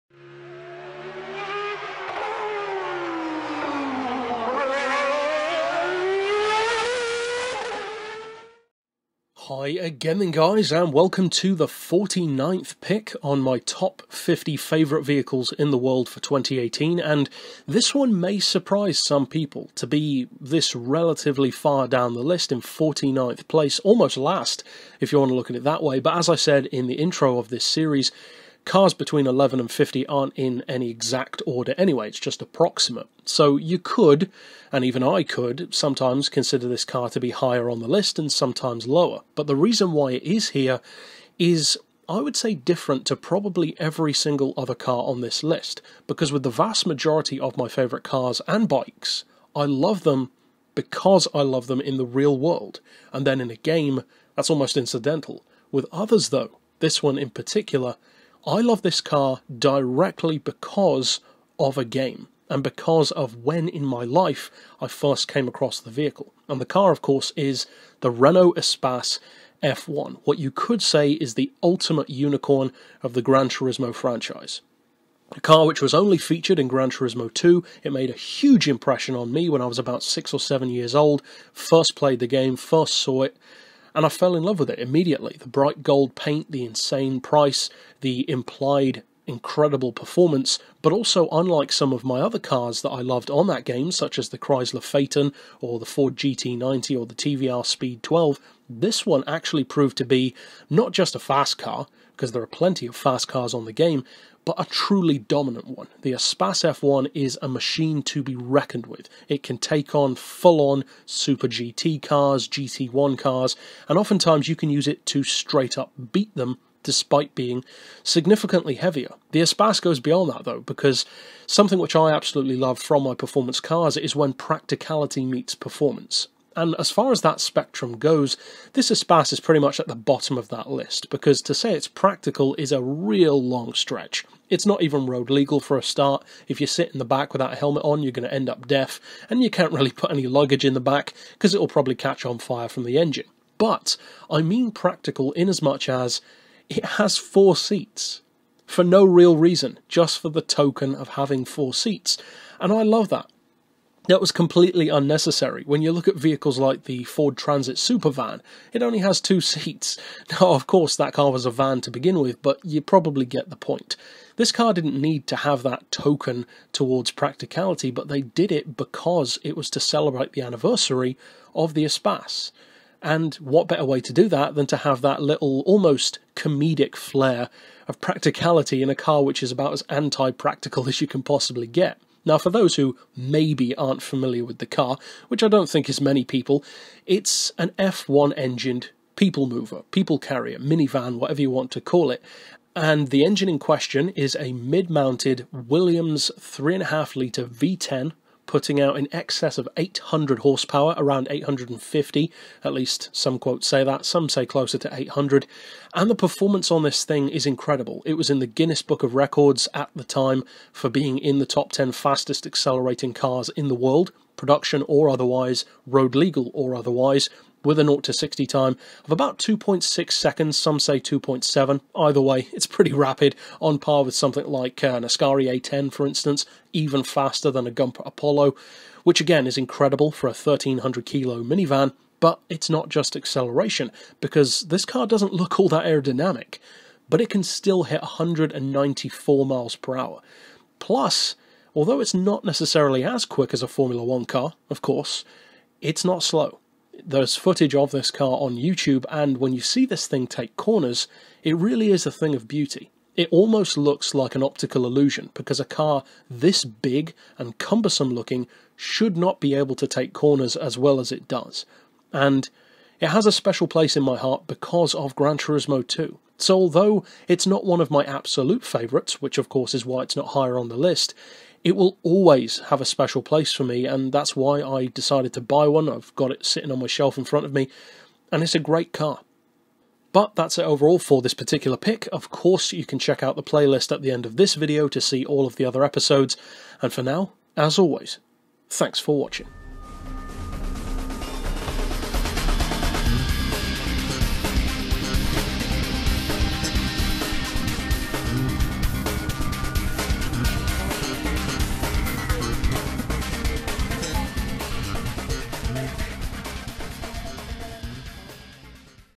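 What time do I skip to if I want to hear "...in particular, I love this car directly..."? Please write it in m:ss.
0:57.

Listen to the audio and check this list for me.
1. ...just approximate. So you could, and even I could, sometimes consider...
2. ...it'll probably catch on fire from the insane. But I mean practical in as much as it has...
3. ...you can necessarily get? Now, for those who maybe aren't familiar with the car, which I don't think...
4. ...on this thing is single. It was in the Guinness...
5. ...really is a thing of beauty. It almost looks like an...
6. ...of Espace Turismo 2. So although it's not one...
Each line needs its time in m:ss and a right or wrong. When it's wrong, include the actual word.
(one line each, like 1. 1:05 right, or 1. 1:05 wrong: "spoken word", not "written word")
1. 0:32 right
2. 2:21 wrong: "engine", not "insane"
3. 3:00 wrong: "possibly", not "necessarily"
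4. 3:26 wrong: "incredible", not "single"
5. 4:11 right
6. 4:24 wrong: "Gran", not "Espace".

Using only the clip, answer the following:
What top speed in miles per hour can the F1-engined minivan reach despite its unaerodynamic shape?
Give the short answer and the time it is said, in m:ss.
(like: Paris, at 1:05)
194, at 3:58.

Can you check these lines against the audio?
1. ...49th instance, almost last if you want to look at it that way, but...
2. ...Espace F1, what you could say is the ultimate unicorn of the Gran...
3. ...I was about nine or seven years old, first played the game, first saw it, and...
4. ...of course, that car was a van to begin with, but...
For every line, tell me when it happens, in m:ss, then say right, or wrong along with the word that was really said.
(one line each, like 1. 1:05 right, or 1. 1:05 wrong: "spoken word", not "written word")
1. 0:22 wrong: "place", not "instance"
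2. 1:08 right
3. 1:19 wrong: "six", not "nine"
4. 2:40 right.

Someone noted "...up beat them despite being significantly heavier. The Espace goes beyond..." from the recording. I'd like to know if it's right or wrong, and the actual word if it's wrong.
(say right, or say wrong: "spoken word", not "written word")
right.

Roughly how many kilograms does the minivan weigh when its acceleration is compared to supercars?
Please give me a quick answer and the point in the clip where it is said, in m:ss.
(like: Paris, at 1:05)
1300, at 3:50.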